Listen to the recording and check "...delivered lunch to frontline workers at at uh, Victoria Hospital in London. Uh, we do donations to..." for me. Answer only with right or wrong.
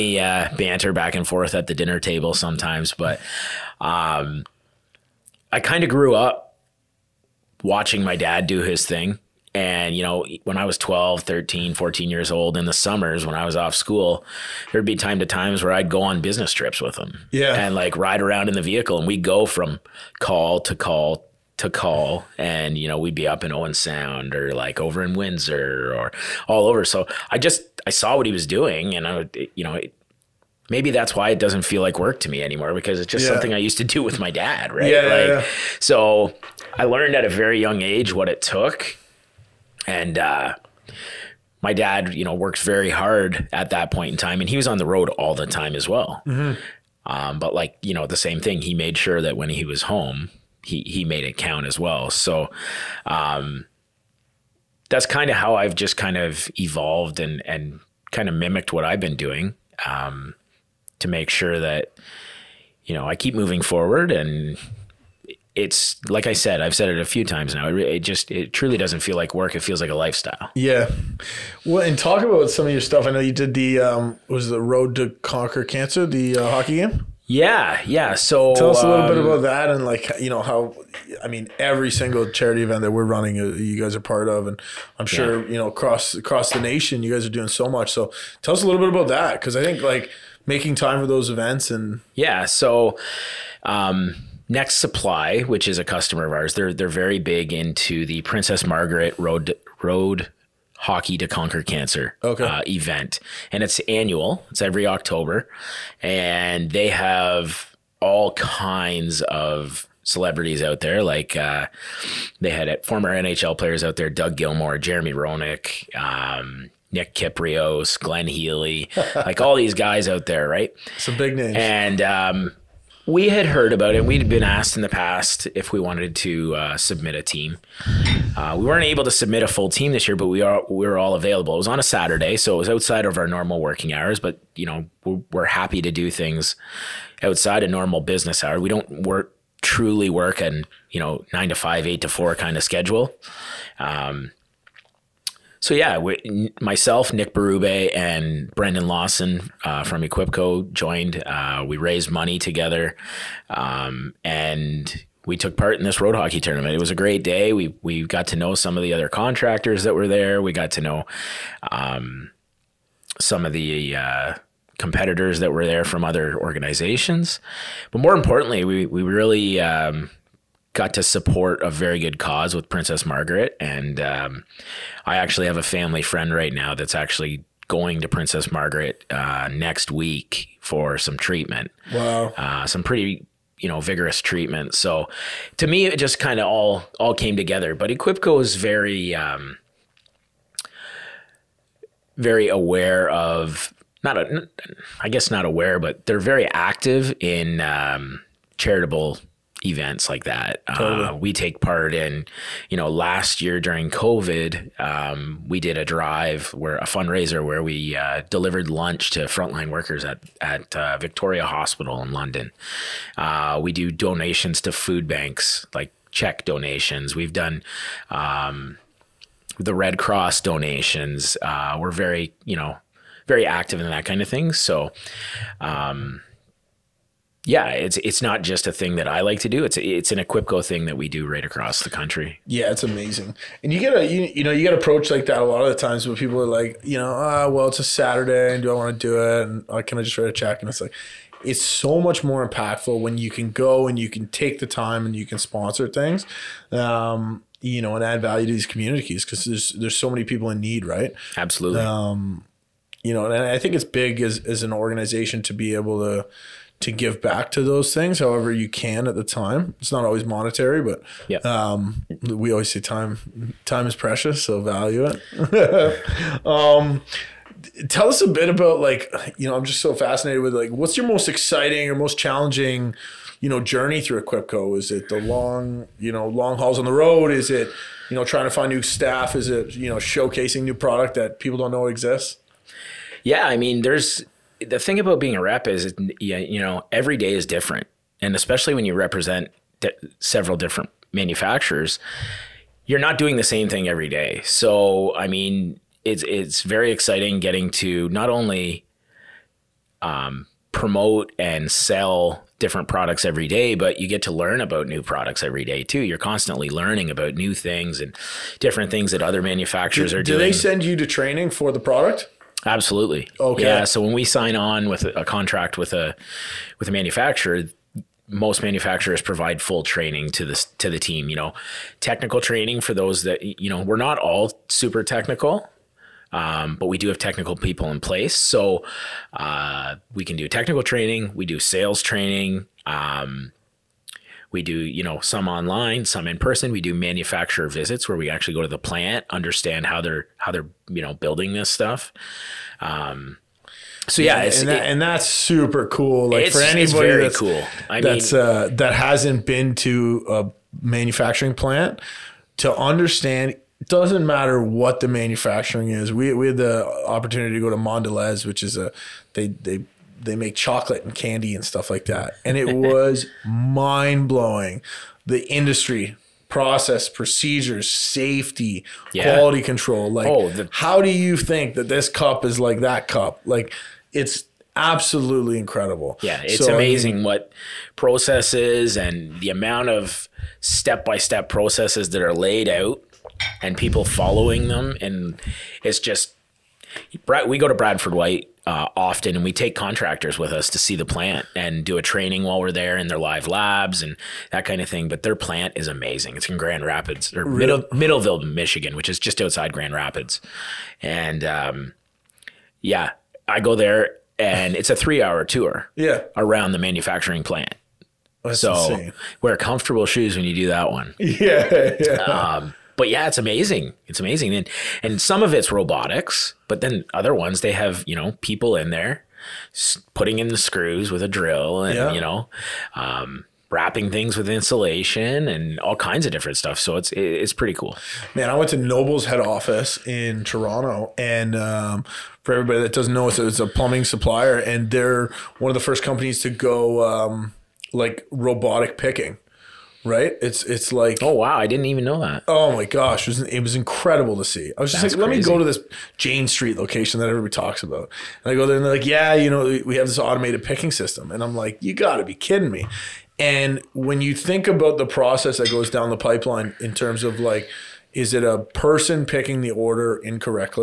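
right.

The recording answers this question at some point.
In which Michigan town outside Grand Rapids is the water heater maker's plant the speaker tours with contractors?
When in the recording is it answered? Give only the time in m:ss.
6:37.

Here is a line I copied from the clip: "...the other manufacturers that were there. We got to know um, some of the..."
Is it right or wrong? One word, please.
wrong.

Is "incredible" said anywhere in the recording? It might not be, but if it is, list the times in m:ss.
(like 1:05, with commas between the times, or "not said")
6:15, 7:23.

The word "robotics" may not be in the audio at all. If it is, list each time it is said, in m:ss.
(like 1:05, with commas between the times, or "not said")
6:55, 7:18.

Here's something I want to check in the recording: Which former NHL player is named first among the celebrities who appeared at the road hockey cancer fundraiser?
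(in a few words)
Doug Gilmour.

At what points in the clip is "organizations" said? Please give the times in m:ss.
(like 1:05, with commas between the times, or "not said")
2:46, 4:14.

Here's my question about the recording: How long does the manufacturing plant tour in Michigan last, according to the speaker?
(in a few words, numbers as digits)
3 hours.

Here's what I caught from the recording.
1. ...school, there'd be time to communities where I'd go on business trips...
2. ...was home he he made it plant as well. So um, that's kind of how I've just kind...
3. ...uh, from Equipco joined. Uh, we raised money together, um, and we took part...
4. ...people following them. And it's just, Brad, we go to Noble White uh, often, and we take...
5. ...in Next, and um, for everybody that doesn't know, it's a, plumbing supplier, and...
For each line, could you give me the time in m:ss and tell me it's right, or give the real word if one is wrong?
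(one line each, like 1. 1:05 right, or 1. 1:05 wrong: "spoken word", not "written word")
1. 0:13 wrong: "times", not "communities"
2. 0:49 wrong: "count", not "plant"
3. 2:29 right
4. 6:23 wrong: "Bradford", not "Noble"
5. 7:10 wrong: "Toronto", not "Next".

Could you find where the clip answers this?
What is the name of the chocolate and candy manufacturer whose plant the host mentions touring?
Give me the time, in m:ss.
5:57.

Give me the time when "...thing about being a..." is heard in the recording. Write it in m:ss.
4:44.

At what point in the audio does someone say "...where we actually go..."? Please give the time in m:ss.
5:38.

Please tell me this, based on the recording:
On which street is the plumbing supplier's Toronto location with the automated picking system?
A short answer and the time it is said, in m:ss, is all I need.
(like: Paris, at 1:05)
Jane Street, at 7:26.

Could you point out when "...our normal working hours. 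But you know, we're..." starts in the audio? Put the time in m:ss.
2:13.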